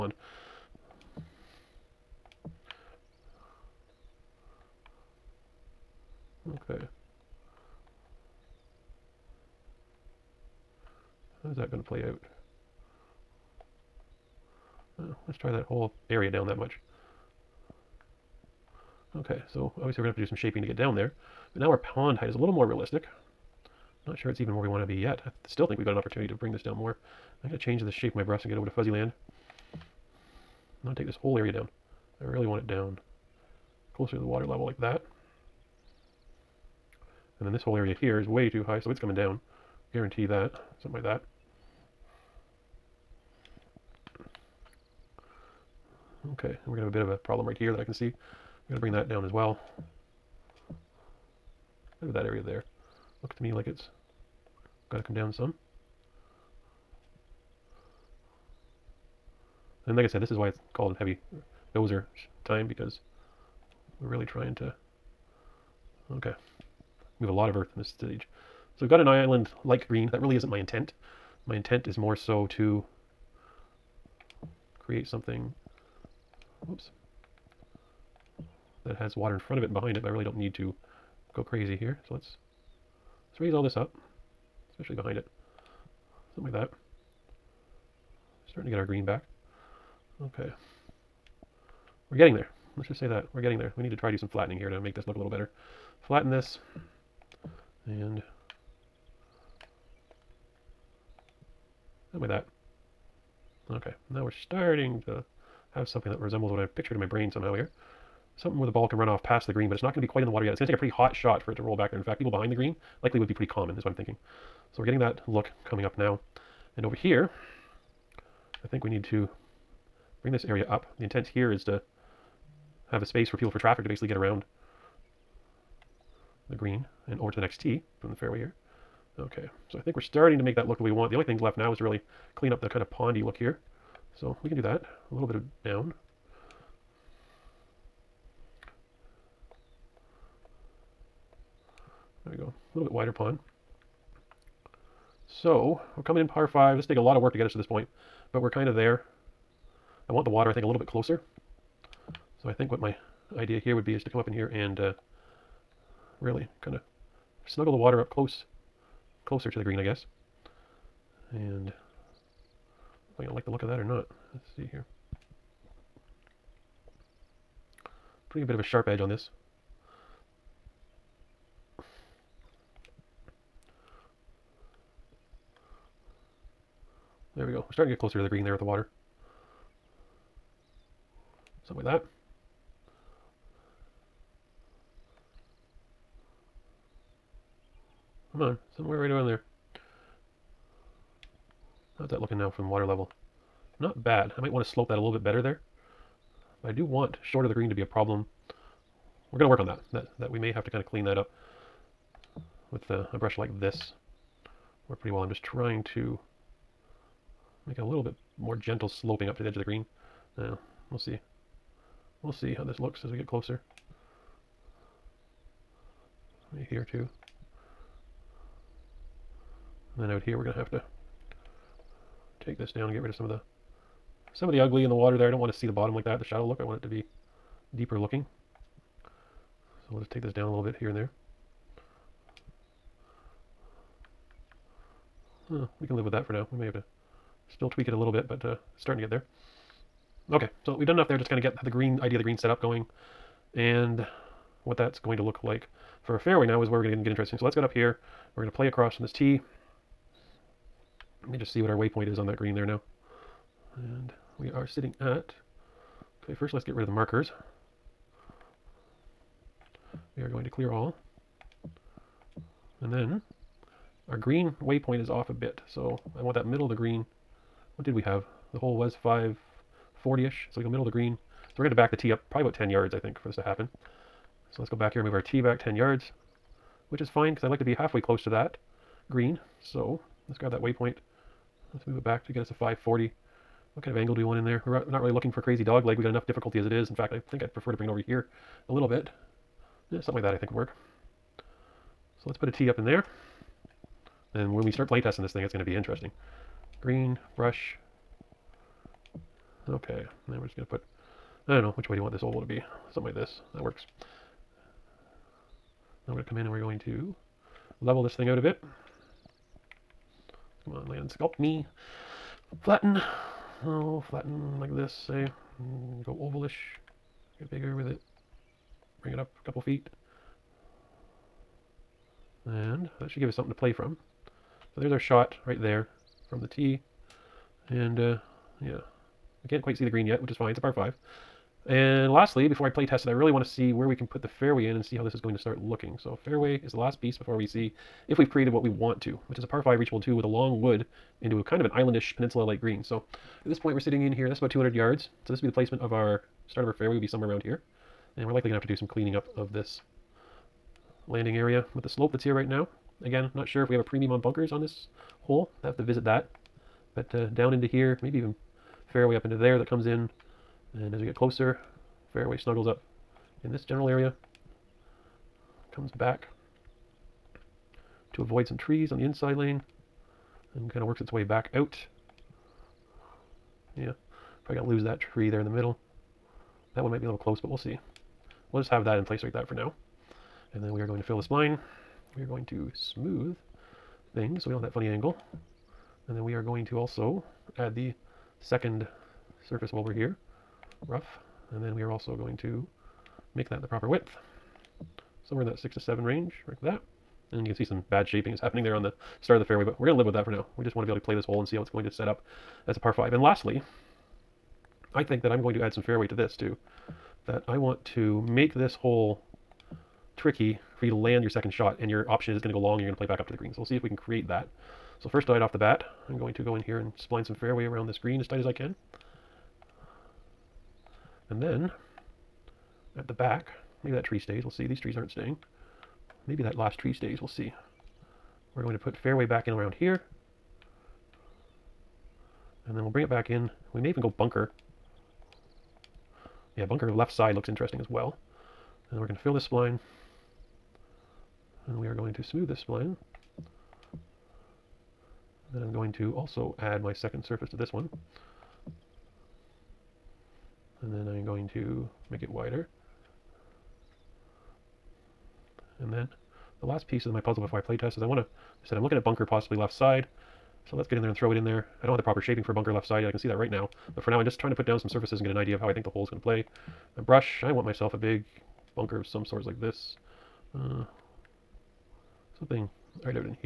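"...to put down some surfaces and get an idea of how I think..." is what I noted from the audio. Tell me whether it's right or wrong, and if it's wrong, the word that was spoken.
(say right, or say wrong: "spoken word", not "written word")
right.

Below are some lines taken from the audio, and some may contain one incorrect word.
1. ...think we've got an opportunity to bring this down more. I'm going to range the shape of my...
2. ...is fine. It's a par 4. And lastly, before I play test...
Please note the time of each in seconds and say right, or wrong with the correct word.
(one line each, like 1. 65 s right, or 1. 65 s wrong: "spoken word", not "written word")
1. 25 s wrong: "change", not "range"
2. 330 s wrong: "5", not "4".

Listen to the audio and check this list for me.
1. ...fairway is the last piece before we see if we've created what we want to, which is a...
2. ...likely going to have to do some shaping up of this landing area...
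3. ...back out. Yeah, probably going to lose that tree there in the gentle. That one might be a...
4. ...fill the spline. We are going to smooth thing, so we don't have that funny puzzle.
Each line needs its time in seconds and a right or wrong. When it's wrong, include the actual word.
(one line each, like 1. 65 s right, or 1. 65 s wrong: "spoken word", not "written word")
1. 336 s right
2. 348 s wrong: "cleaning", not "shaping"
3. 371 s wrong: "middle", not "gentle"
4. 381 s wrong: "angle", not "puzzle".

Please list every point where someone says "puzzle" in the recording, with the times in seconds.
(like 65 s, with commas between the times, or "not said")
457 s.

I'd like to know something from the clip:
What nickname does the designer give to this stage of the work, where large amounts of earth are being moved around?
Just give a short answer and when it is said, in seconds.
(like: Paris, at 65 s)
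Heavy dozer time, at 60 s.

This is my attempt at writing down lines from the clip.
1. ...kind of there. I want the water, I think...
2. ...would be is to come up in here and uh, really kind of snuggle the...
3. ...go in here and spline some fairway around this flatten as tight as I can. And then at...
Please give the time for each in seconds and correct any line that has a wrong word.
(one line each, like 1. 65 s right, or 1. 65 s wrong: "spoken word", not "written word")
1. 148 s right
2. 153 s right
3. 416 s wrong: "green", not "flatten".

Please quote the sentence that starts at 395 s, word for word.
Somewhere in that six to seven range, like that.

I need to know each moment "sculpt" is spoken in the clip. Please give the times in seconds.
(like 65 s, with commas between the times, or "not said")
311 s.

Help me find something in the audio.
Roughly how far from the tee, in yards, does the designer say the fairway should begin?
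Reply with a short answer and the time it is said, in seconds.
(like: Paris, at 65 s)
200, at 344 s.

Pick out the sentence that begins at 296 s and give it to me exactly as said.
Green, brush, Okay, then we're just going to put, I don't know, which way do you want this oval to be?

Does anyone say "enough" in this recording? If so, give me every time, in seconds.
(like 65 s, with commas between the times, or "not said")
240 s, 286 s.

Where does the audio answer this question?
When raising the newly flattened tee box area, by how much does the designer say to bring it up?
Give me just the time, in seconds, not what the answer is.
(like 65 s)
319 s.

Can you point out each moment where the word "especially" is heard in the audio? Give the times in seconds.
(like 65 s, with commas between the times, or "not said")
84 s.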